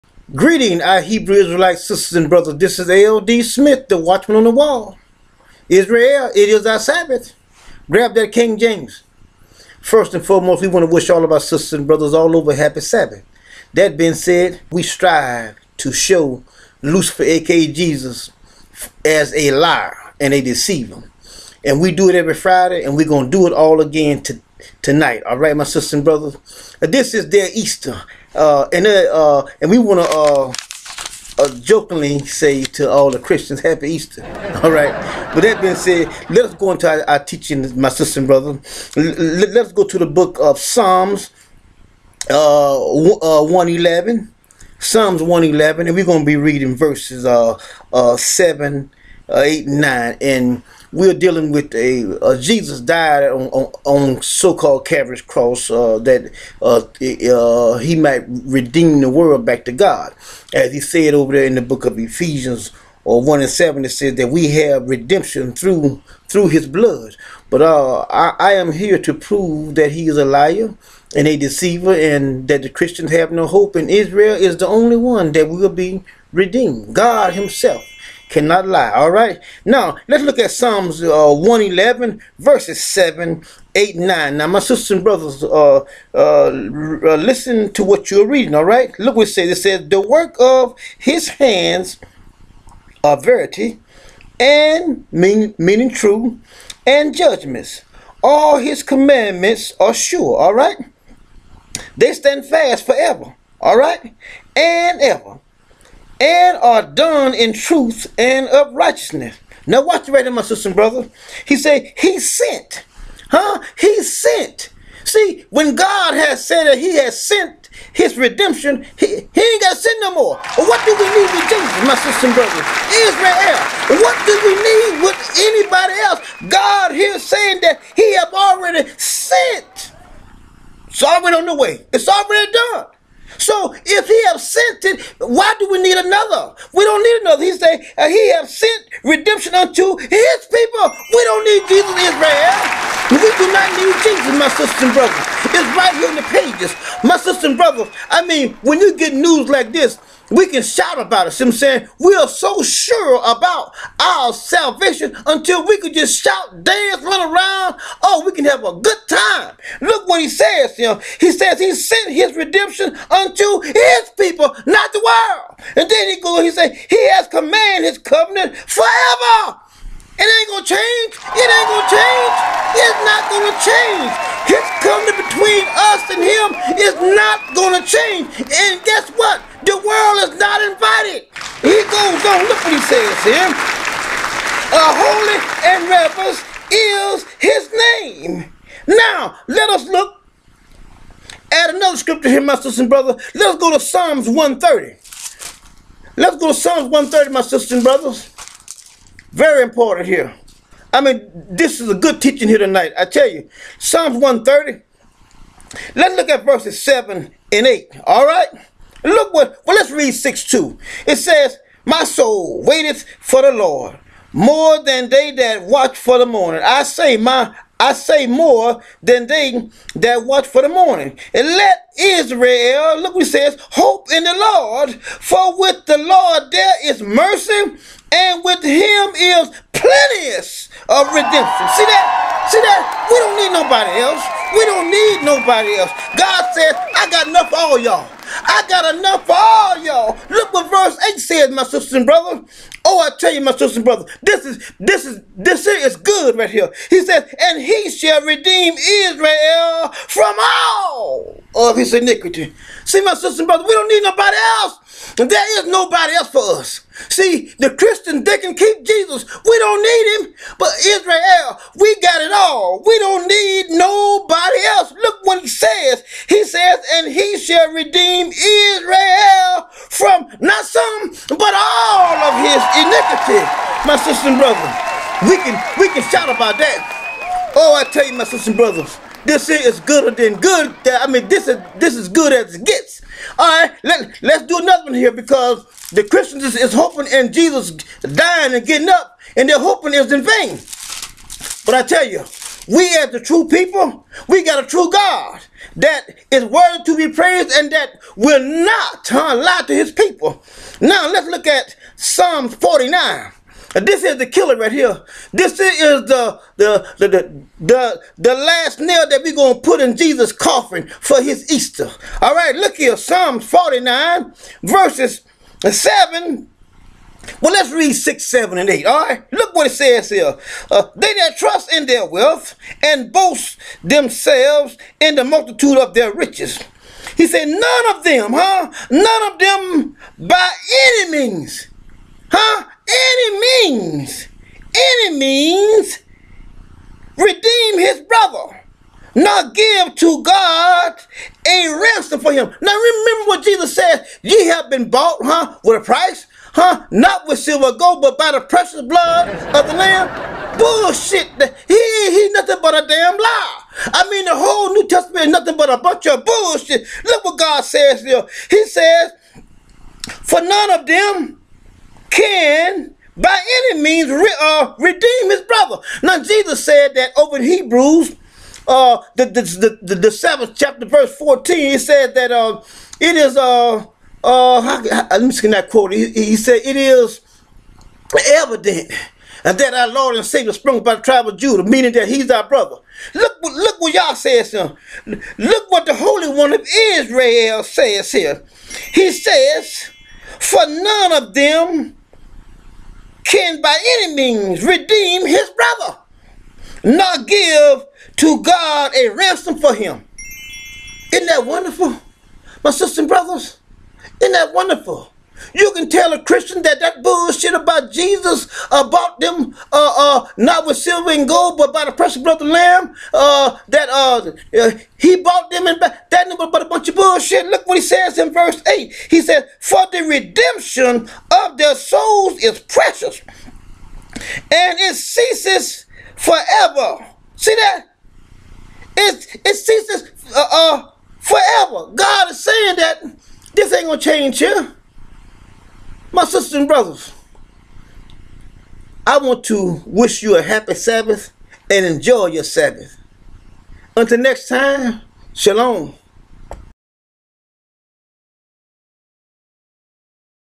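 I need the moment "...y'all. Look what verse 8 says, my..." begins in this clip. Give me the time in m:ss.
3:59.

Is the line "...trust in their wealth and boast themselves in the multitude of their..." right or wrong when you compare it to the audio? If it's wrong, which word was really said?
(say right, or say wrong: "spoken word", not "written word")
right.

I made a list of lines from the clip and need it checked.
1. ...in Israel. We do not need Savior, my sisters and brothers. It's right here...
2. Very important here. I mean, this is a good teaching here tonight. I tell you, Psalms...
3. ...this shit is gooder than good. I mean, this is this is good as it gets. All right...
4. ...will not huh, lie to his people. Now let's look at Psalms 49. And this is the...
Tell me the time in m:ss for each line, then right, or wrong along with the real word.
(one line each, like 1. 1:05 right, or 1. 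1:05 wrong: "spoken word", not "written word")
1. 2:21 wrong: "Jesus", not "Savior"
2. 3:19 right
3. 4:39 right
4. 4:58 right.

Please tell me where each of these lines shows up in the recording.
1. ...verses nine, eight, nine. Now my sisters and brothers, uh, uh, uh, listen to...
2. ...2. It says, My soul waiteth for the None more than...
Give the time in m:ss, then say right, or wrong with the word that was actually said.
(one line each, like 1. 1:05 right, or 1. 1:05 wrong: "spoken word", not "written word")
1. 1:22 wrong: "seven", not "nine"
2. 3:30 wrong: "Lord", not "None".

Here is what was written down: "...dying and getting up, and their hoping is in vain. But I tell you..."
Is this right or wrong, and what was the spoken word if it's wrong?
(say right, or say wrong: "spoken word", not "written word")
right.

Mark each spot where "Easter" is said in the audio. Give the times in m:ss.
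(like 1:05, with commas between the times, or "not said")
0:27, 0:33, 5:11.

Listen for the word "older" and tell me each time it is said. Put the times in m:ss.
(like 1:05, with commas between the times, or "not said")
not said.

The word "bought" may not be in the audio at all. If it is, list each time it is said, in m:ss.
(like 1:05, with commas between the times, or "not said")
5:44, 6:55.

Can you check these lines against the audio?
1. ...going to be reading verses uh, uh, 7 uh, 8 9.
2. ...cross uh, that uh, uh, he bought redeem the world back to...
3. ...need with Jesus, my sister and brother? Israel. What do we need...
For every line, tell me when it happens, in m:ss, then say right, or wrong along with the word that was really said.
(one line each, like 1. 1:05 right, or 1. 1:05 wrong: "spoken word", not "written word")
1. 0:46 right
2. 0:55 wrong: "might", not "bought"
3. 2:01 right.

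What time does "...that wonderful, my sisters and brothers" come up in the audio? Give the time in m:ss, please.
6:41.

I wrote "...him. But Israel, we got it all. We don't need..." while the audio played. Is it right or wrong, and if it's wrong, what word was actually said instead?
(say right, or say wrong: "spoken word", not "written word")
right.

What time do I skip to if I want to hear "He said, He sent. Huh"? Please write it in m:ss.
1:51.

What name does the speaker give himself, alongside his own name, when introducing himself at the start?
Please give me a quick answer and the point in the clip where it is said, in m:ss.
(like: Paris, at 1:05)
the watchman on the wall, at 0:03.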